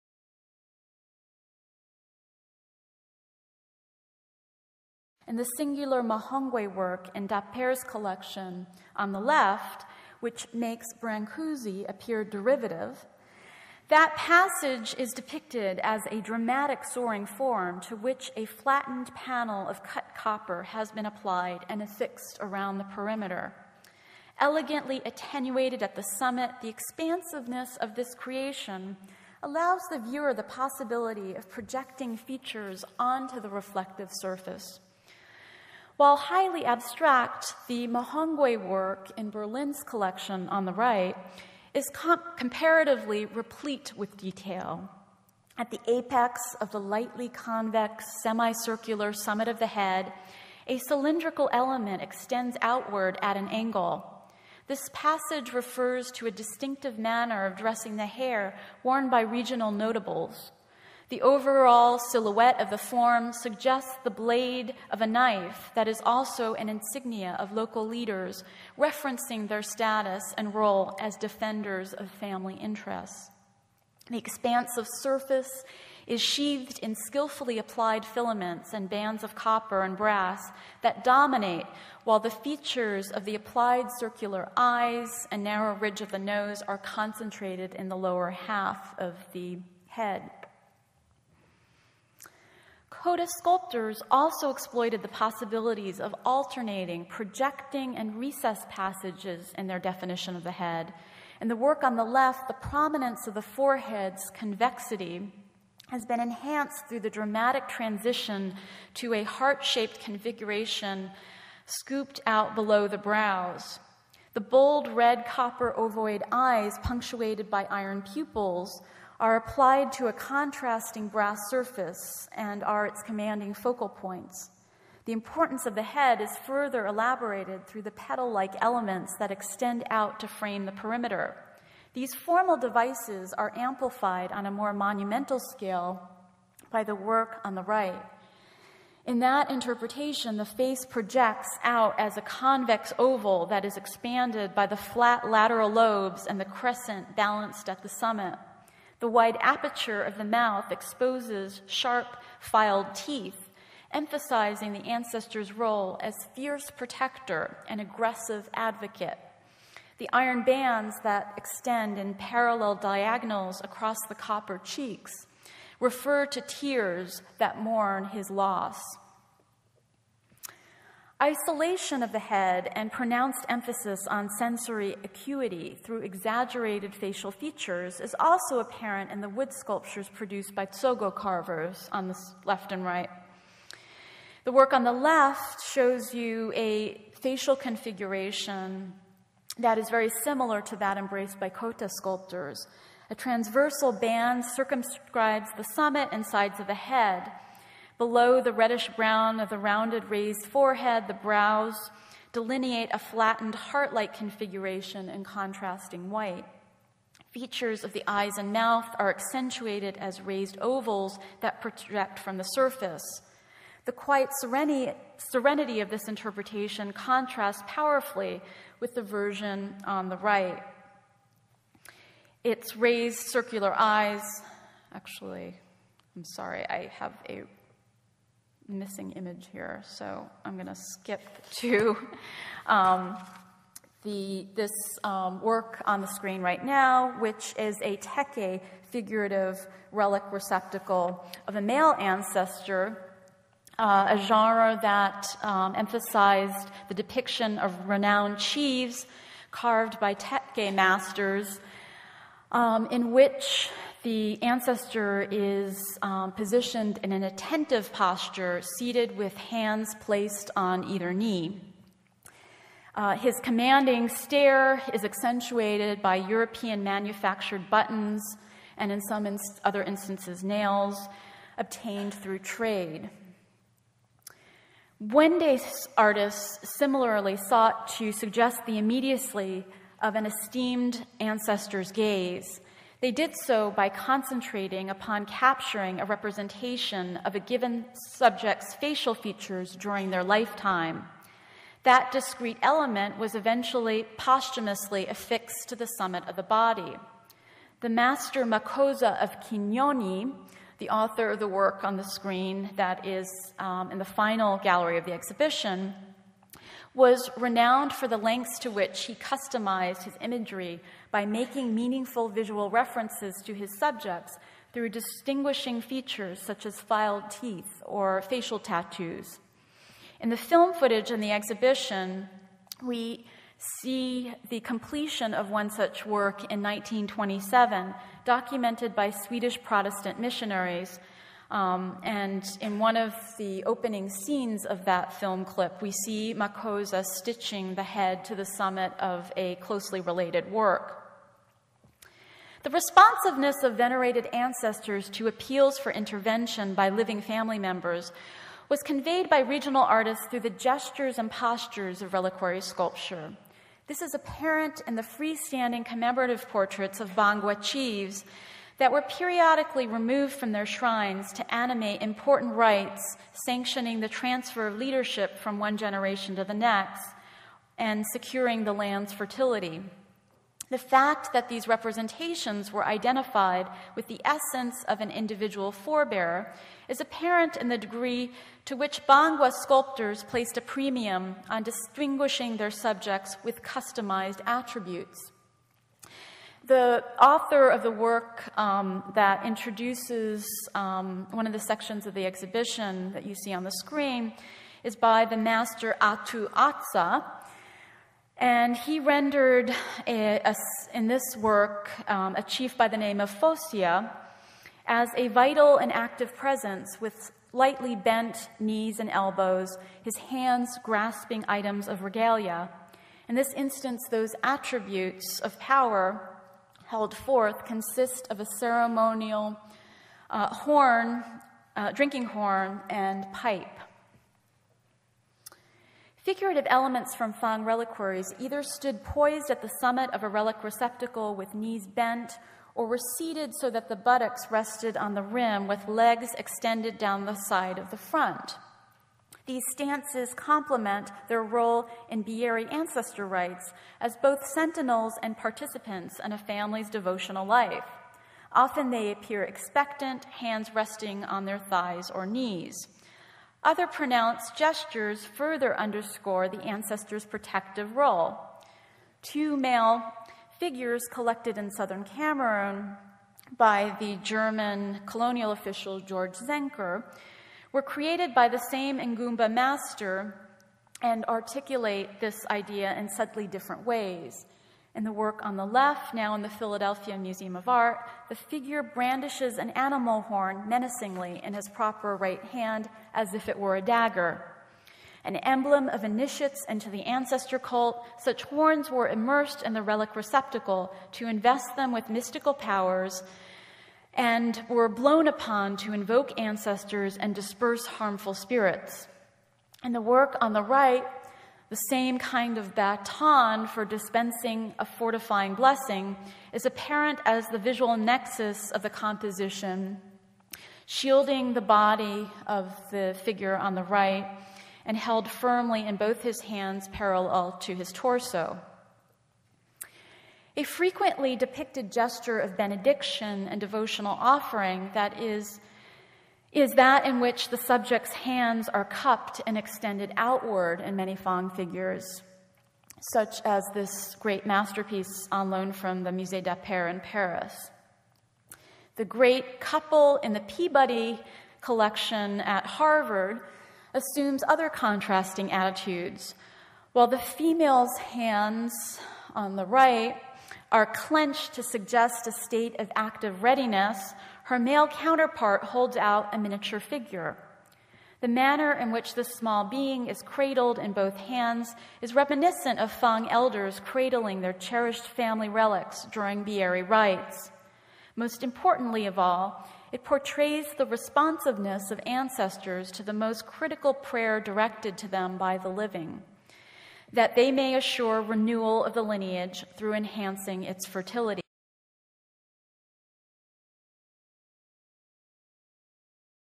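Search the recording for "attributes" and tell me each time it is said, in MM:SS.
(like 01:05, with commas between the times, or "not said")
06:24, 06:54.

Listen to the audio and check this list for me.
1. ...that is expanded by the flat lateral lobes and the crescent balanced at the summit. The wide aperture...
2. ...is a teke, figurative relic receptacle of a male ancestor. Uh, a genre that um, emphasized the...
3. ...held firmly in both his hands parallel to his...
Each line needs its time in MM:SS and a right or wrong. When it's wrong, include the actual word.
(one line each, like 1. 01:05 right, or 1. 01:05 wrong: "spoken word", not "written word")
1. 02:23 right
2. 03:57 right
3. 08:34 right.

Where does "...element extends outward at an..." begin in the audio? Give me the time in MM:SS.
00:51.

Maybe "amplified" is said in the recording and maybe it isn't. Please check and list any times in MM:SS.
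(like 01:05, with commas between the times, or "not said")
02:13.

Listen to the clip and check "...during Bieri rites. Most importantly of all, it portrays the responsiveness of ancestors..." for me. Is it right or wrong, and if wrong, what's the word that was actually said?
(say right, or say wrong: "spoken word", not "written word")
right.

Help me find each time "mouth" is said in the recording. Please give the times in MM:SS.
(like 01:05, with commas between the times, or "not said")
02:30, 03:28.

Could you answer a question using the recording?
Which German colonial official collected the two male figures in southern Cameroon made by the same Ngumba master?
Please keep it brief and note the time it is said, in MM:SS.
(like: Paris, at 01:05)
George Zenker, at 07:45.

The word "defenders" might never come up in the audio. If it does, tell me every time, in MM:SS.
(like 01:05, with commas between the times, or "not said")
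01:11.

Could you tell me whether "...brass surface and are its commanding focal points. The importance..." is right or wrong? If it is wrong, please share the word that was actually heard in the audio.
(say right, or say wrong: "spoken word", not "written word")
right.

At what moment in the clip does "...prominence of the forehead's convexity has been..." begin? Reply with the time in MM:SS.
01:42.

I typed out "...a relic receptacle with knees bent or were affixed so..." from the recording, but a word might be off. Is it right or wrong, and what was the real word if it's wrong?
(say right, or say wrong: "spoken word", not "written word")
wrong: "seated", not "affixed".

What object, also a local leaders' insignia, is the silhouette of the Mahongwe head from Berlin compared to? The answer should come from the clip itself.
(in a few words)
Blade of a knife.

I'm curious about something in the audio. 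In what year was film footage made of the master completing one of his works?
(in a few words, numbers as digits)
1927.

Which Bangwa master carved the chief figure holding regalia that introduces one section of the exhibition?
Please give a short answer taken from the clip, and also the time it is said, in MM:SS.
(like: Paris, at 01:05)
Atu Atsa, at 06:35.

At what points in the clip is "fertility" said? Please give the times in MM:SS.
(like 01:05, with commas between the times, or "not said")
06:09, 09:40.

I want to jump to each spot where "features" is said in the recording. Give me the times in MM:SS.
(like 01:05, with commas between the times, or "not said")
00:32, 01:22, 02:57, 03:27, 04:49, 05:15.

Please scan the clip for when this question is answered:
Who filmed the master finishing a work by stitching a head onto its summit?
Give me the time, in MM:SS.
05:29.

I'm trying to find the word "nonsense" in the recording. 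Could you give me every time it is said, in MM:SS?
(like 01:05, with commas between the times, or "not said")
not said.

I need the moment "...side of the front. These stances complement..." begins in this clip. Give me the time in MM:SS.
07:17.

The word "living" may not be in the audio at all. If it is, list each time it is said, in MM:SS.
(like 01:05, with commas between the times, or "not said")
05:46, 09:35.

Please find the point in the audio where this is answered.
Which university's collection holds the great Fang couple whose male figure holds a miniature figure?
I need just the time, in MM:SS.
09:02.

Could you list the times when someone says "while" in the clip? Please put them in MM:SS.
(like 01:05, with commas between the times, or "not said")
00:36, 01:22, 09:06.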